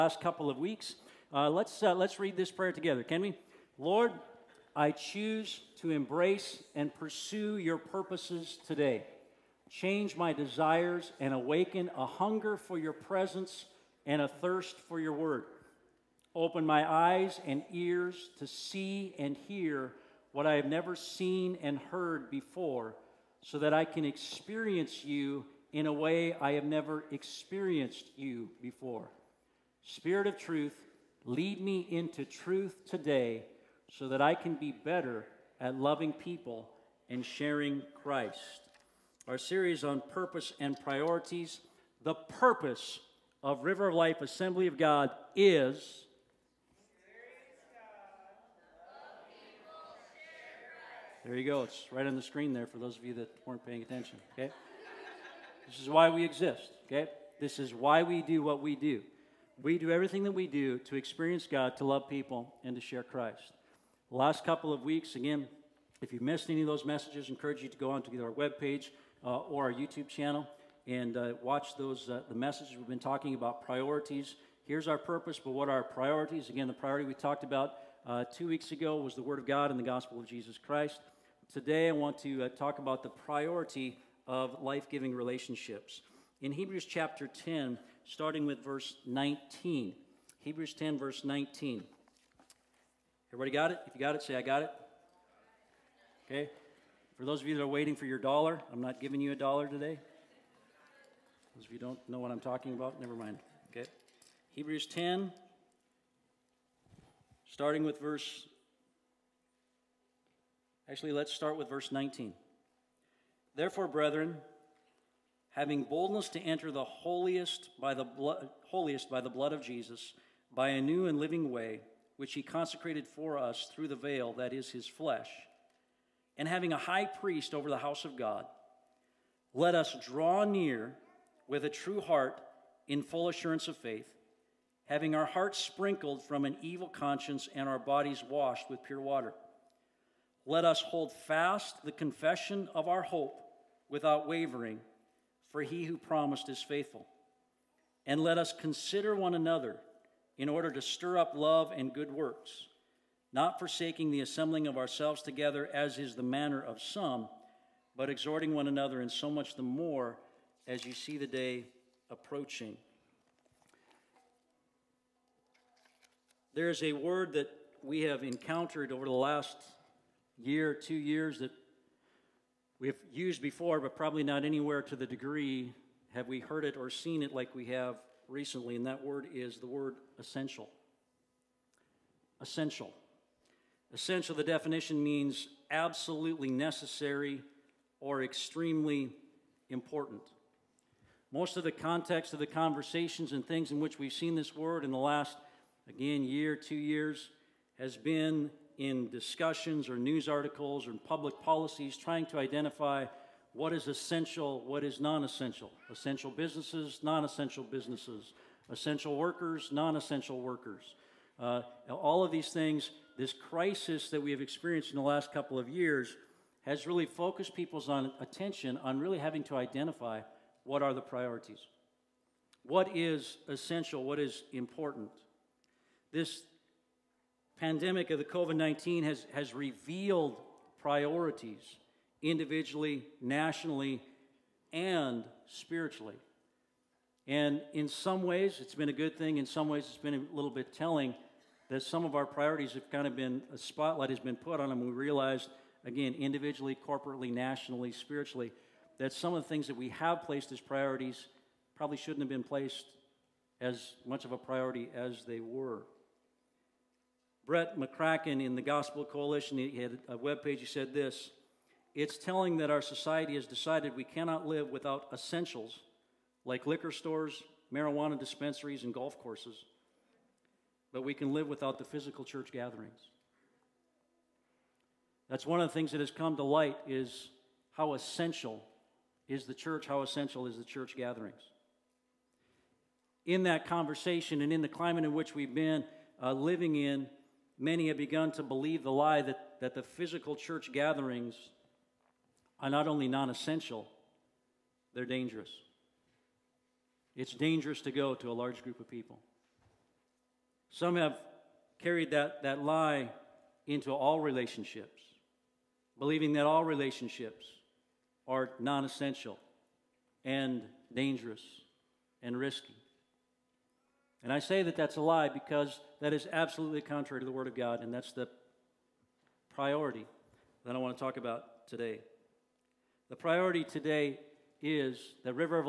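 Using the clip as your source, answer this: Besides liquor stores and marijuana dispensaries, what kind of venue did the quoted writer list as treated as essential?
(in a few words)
Golf courses.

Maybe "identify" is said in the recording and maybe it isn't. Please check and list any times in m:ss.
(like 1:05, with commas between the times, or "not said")
3:22, 3:39.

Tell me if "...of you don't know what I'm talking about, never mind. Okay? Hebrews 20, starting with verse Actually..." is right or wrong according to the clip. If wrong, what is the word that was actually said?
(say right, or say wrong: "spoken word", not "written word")
wrong: "10", not "20".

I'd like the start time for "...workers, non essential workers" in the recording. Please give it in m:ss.
3:29.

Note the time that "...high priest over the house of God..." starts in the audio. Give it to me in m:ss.
2:06.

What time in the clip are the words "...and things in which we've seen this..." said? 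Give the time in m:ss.
3:13.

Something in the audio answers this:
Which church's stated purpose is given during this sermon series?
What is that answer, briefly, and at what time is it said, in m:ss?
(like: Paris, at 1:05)
River of Life Assembly of God, at 0:43.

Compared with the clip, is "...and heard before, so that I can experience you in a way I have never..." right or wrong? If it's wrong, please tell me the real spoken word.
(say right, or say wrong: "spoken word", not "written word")
right.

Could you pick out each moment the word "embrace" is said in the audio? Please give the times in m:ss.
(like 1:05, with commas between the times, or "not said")
0:05.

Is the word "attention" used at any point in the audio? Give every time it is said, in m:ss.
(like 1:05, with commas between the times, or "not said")
0:53, 3:38.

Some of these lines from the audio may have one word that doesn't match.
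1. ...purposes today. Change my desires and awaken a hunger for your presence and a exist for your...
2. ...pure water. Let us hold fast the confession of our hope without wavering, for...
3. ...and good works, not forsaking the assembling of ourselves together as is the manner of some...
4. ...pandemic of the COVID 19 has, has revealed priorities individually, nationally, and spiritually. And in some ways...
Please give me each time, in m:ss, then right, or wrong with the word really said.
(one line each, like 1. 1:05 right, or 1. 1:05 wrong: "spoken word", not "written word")
1. 0:07 wrong: "thirst", not "exist"
2. 2:18 right
3. 2:31 right
4. 3:47 right.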